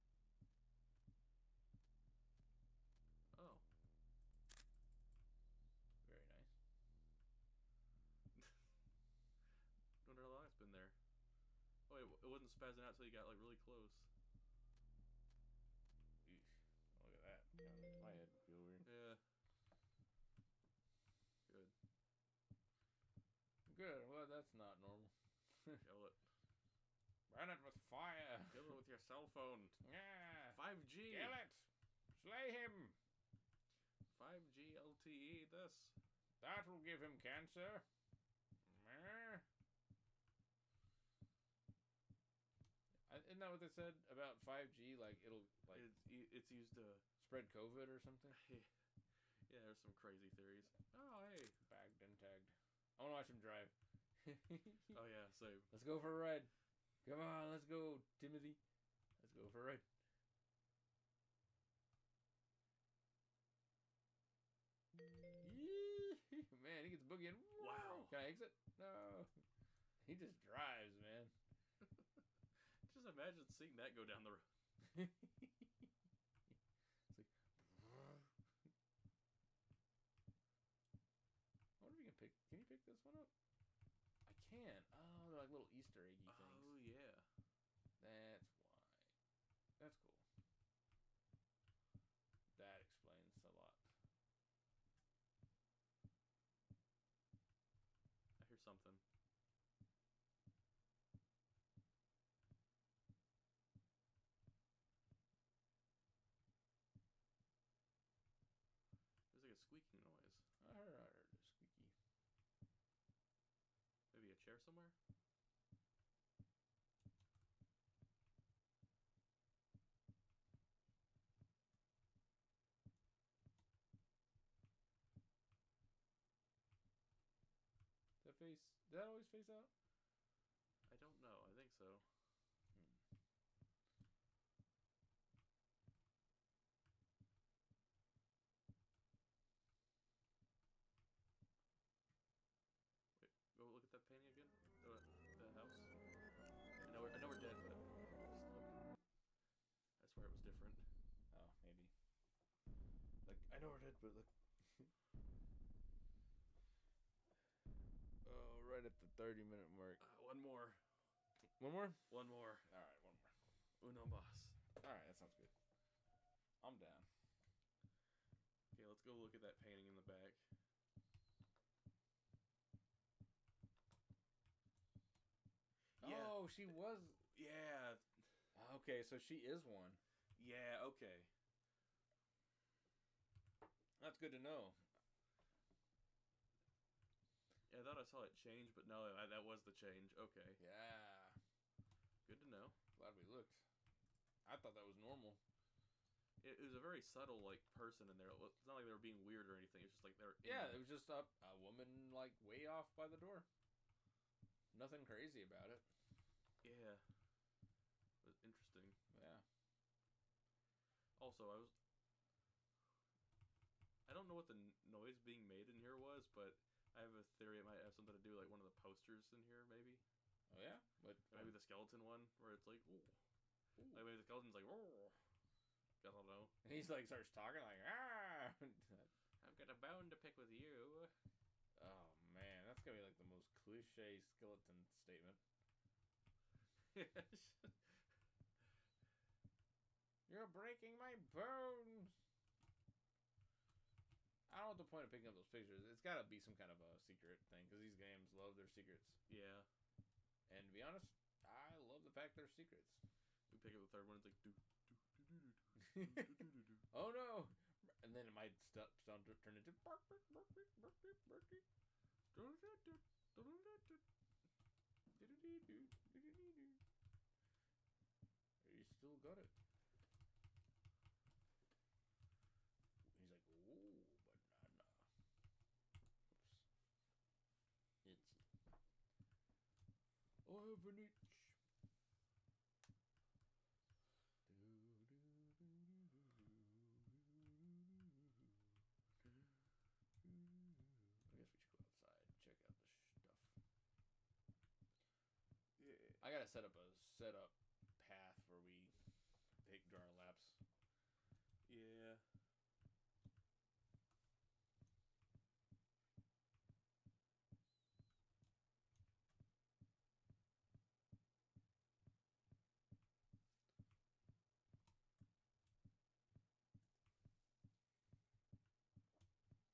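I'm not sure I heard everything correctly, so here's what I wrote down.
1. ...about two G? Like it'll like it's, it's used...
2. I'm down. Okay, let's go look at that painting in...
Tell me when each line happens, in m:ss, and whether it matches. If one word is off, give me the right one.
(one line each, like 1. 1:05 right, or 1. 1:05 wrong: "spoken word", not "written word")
1. 0:44 wrong: "five", not "two"
2. 2:46 right.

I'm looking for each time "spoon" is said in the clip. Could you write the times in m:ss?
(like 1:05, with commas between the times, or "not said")
not said.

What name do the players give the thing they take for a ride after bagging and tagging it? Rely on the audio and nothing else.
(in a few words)
Timothy.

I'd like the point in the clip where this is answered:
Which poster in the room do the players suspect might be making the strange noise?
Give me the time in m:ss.
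3:41.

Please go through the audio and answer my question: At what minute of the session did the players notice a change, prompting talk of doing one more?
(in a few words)
30.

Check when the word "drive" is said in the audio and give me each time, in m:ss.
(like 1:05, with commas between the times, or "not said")
0:53, 1:10.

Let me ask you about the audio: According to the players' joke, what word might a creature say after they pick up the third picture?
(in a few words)
banana.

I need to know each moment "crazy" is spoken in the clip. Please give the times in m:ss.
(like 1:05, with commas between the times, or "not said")
0:49, 3:25.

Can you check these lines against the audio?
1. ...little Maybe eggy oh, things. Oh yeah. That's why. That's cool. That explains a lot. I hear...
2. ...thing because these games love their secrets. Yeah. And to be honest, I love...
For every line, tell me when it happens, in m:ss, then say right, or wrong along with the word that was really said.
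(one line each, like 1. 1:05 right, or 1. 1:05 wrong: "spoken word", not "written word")
1. 1:25 wrong: "Easter", not "Maybe"
2. 4:07 right.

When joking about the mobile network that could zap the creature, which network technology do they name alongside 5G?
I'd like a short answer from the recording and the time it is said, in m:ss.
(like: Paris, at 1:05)
LTE, at 0:34.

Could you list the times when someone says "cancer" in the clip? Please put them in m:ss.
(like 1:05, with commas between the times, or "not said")
0:37.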